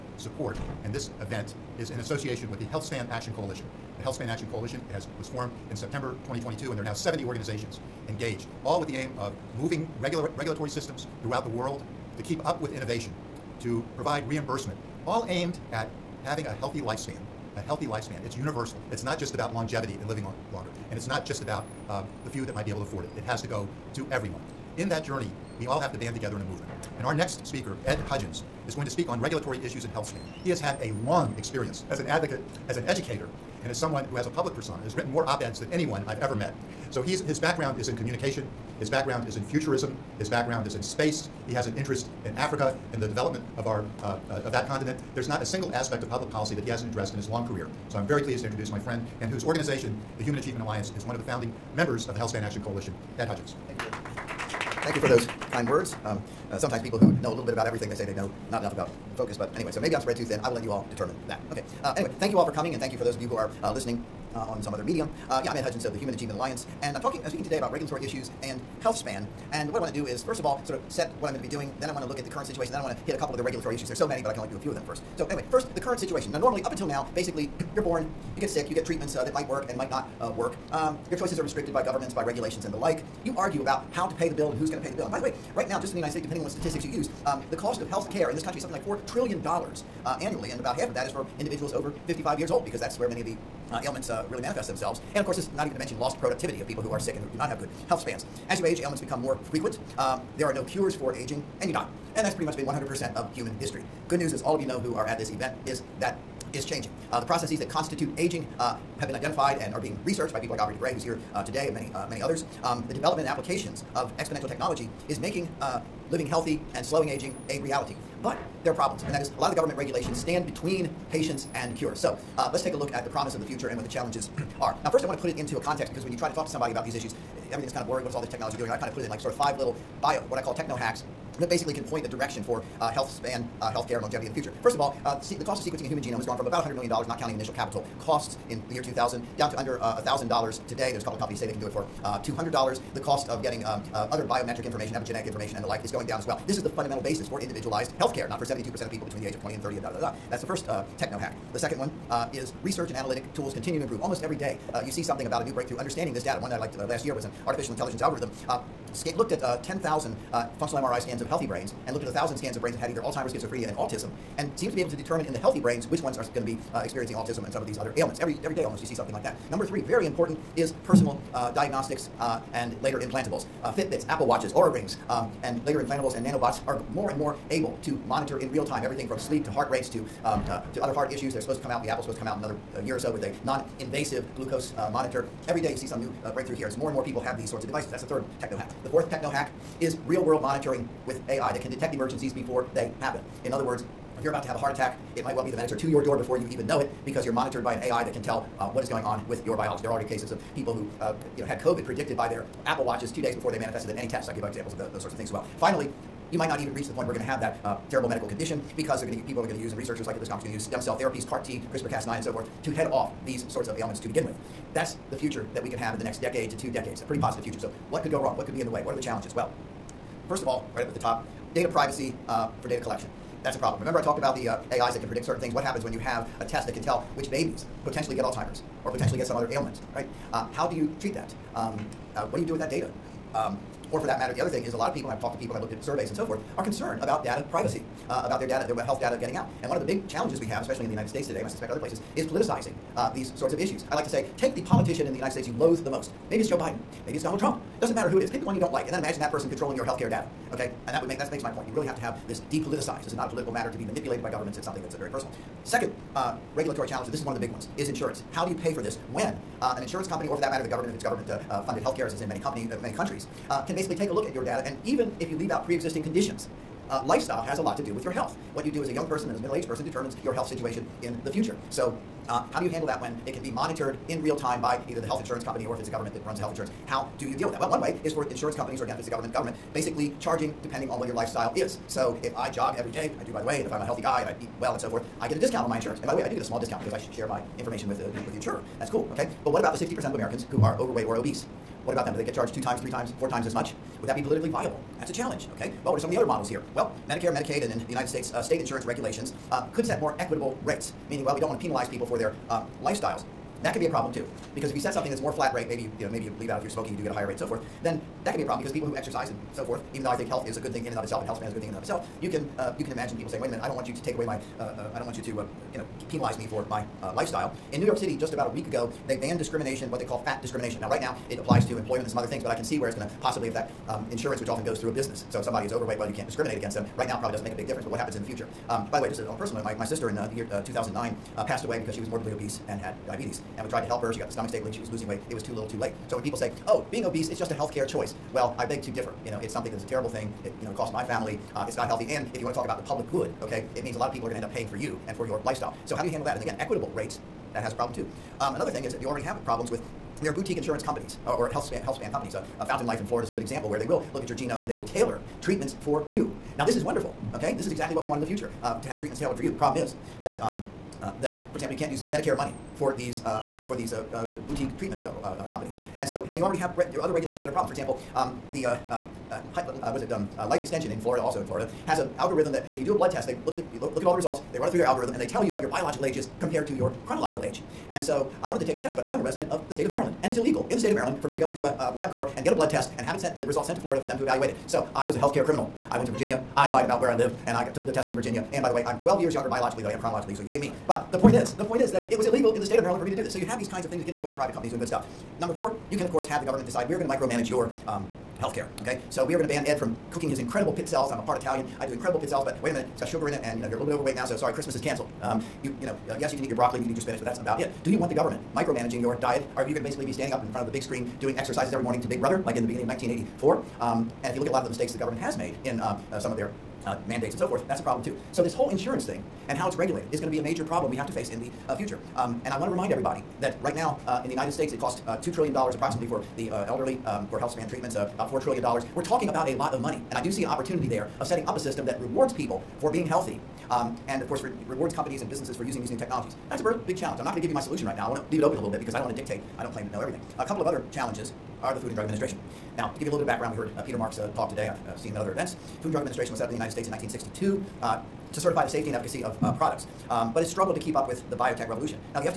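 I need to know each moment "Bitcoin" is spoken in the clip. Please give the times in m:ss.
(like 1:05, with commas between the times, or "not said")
not said.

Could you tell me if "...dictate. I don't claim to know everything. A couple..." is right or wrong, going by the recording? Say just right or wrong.
right.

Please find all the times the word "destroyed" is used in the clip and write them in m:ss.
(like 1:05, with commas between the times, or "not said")
not said.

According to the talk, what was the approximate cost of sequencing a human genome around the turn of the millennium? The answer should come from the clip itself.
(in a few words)
$100 million.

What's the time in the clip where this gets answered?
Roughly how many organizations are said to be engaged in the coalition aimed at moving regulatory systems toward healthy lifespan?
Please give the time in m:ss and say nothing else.
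0:06.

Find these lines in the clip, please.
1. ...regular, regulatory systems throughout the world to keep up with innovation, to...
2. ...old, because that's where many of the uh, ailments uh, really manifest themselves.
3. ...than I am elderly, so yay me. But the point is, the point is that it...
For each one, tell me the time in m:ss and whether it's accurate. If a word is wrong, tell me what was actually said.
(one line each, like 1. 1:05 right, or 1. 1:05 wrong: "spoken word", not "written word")
1. 0:10 right
2. 1:32 right
3. 6:29 wrong: "chronologically", not "elderly".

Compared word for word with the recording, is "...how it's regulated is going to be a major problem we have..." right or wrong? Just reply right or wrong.
right.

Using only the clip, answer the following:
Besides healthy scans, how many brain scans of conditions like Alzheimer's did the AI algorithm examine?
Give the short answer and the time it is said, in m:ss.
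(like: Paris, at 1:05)
1,000, at 2:42.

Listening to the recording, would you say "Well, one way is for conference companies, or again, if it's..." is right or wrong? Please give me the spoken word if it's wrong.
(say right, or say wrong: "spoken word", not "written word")
wrong: "insurance", not "conference".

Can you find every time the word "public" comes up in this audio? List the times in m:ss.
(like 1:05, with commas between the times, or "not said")
0:34, 0:46, 5:42.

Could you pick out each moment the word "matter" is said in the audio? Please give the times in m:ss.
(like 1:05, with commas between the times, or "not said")
3:54, 4:07, 4:13, 4:20.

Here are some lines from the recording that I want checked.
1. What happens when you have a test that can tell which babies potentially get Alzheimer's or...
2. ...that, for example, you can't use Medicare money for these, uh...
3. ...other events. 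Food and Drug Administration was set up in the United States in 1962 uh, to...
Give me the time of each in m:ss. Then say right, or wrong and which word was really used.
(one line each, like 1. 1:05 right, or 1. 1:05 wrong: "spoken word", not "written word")
1. 3:45 right
2. 6:01 right
3. 7:25 right.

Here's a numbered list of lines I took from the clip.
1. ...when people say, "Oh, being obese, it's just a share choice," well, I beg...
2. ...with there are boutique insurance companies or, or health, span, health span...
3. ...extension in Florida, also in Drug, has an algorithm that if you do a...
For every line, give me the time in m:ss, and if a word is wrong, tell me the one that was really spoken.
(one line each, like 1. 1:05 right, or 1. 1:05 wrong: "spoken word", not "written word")
1. 5:36 wrong: "healthcare", not "share"
2. 5:49 right
3. 6:10 wrong: "Florida", not "Drug".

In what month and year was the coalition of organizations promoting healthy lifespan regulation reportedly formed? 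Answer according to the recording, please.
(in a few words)
September 2022.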